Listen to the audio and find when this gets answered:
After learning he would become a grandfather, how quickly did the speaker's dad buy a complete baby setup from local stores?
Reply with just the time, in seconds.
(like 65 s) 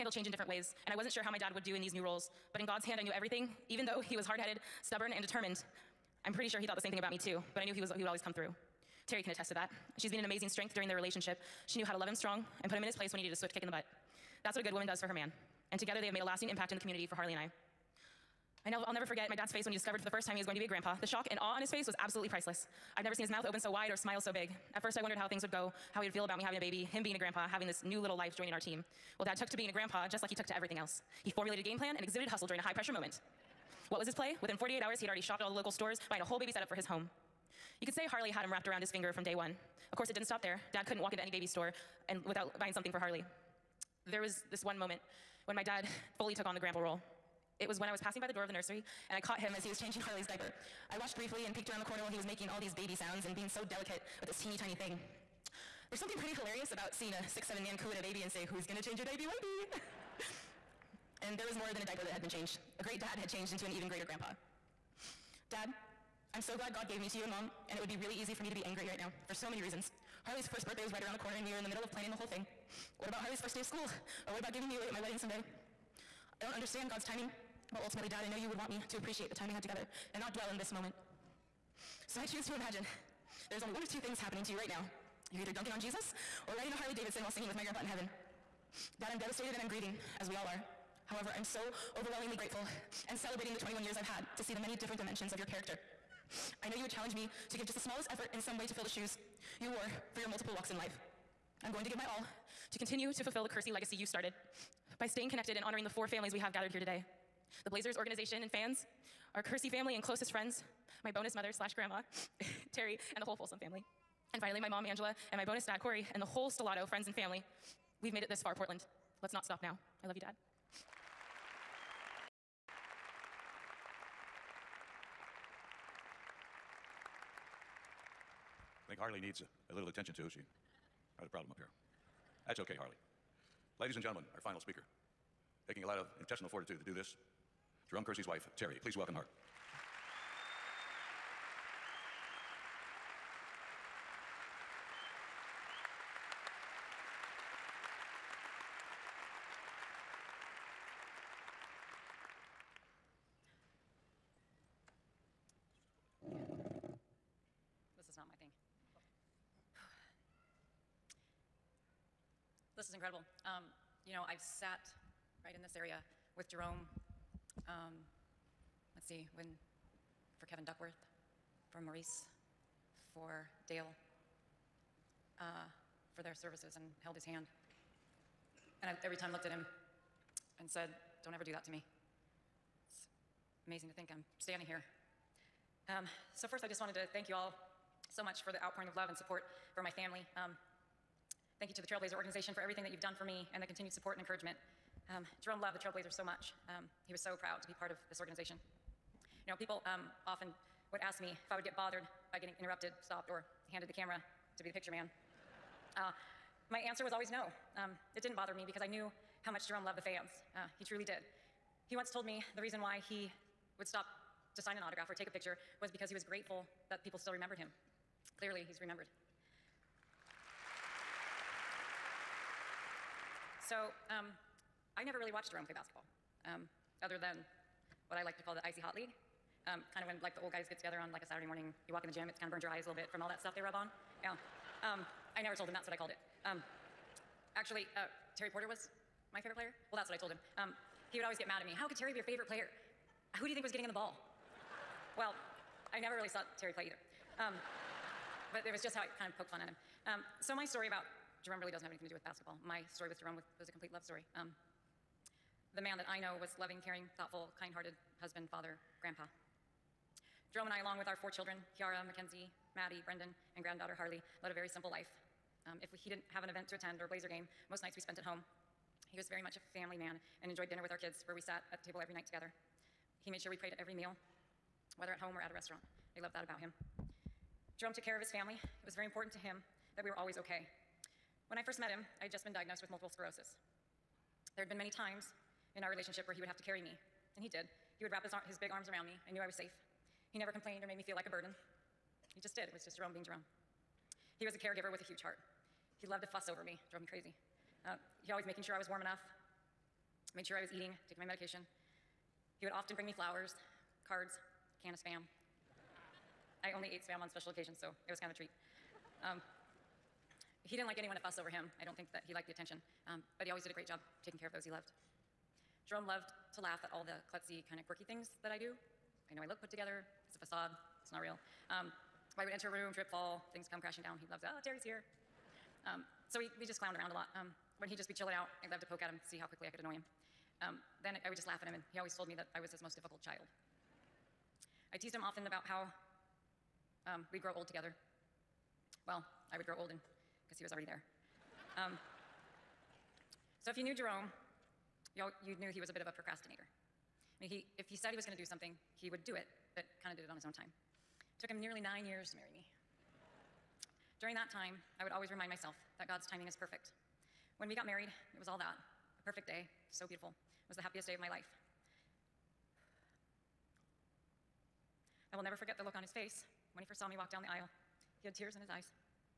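34 s.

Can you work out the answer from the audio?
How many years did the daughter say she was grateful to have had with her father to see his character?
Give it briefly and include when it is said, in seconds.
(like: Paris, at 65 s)
21 years, at 93 s.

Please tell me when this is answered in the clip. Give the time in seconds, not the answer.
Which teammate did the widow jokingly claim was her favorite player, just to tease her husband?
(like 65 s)
238 s.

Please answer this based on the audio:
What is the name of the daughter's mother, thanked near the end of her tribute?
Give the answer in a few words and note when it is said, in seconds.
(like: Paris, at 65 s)
Angela, at 114 s.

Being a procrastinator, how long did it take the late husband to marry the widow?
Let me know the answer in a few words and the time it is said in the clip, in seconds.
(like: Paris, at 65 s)
9 years, at 351 s.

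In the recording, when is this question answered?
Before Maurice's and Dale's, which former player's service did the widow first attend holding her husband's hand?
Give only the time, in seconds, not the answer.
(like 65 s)
170 s.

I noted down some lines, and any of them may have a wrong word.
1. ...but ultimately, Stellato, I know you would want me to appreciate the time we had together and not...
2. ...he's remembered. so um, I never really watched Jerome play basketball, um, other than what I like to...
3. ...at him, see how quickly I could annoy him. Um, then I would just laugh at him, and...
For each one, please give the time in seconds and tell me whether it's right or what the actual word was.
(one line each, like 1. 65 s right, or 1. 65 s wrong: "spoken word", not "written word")
1. 77 s wrong: "Dad", not "Stellato"
2. 218 s right
3. 329 s right.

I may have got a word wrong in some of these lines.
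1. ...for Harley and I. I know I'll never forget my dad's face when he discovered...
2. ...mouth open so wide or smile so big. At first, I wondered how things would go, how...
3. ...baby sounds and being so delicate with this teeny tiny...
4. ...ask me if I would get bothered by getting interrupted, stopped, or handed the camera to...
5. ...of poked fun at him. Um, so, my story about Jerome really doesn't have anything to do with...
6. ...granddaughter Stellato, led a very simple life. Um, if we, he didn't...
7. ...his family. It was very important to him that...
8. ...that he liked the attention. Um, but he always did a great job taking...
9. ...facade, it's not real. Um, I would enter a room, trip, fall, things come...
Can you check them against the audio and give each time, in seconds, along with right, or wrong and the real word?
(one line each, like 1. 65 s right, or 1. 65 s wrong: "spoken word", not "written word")
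1. 17 s right
2. 23 s right
3. 52 s right
4. 201 s right
5. 249 s right
6. 263 s wrong: "Harley", not "Stellato"
7. 278 s right
8. 312 s right
9. 320 s right.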